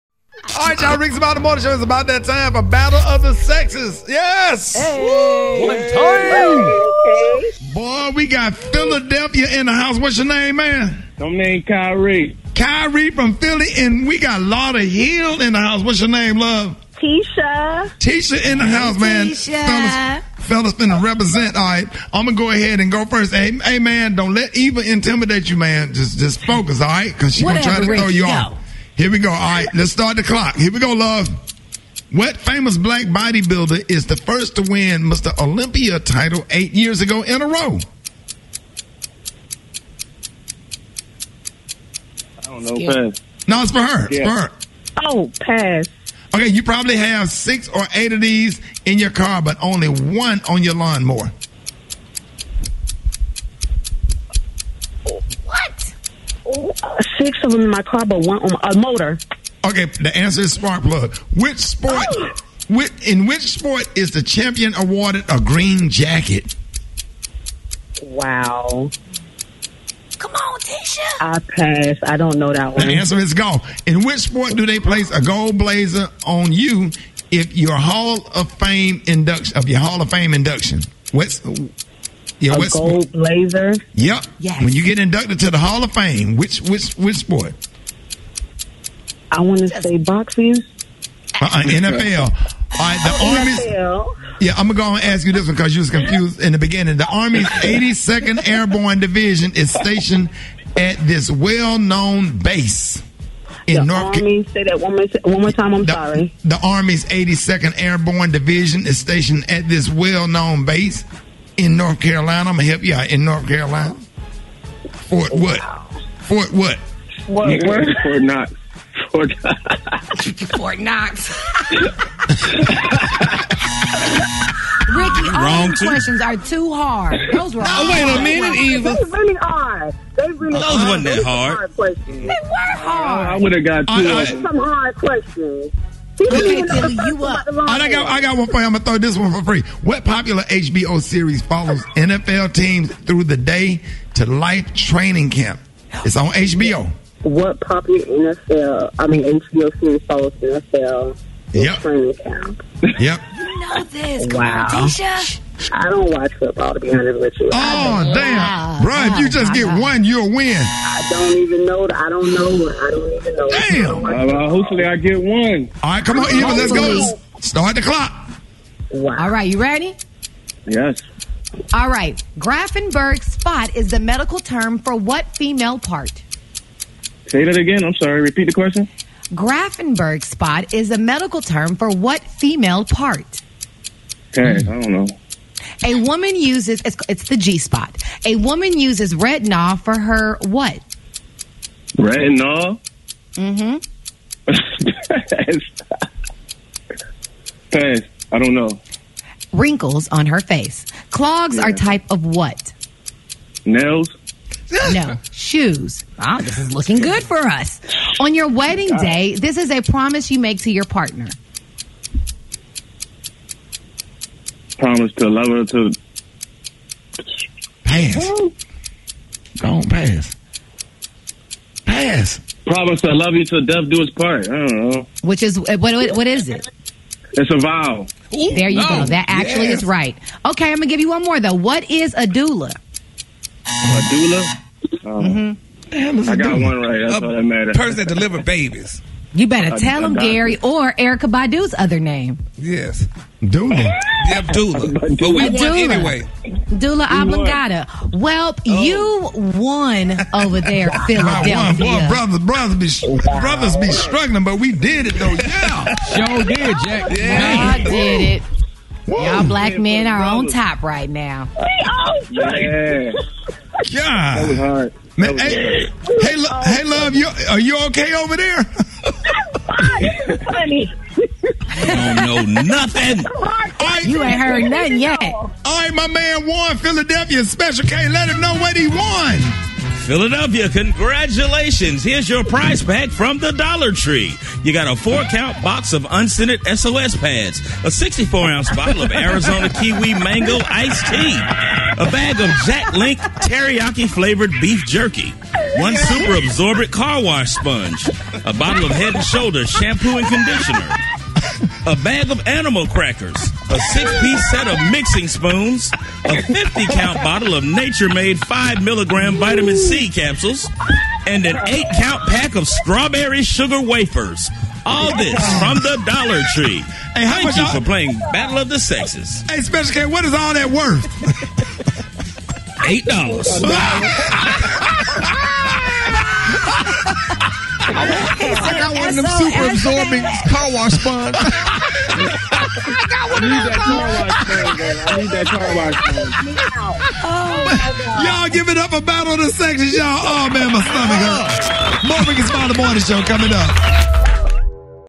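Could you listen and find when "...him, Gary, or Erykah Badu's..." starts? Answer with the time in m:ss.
4:00.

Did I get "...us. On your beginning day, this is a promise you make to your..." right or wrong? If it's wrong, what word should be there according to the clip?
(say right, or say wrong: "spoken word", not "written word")
wrong: "wedding", not "beginning".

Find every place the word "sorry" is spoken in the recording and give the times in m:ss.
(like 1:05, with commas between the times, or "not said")
1:45, 2:57.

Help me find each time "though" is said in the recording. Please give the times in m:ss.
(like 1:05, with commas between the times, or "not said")
3:51, 4:15.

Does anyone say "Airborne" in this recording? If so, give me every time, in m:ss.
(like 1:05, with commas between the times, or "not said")
1:38, 1:47.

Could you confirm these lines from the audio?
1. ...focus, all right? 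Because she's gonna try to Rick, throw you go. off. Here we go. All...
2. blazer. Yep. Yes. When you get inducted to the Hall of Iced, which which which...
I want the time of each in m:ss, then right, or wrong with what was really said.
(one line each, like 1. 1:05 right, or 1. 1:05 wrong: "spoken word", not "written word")
1. 0:26 right
2. 1:23 wrong: "Fame", not "Iced".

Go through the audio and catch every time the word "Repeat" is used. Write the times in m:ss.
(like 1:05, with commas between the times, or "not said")
2:58.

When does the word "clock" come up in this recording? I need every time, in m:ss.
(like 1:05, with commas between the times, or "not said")
0:30, 2:47.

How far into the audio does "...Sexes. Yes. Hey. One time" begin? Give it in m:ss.
0:03.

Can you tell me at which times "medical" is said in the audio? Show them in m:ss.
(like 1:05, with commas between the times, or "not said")
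2:53, 3:00.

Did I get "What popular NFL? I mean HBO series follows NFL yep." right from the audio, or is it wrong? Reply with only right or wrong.
right.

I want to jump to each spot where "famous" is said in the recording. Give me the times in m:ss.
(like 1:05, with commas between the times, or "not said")
0:32.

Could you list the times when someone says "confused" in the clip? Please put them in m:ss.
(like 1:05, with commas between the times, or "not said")
1:35.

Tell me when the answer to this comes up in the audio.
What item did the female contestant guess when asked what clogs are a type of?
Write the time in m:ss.
3:23.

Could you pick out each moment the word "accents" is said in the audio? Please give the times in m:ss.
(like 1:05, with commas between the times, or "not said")
not said.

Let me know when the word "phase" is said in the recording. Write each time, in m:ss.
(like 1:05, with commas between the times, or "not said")
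not said.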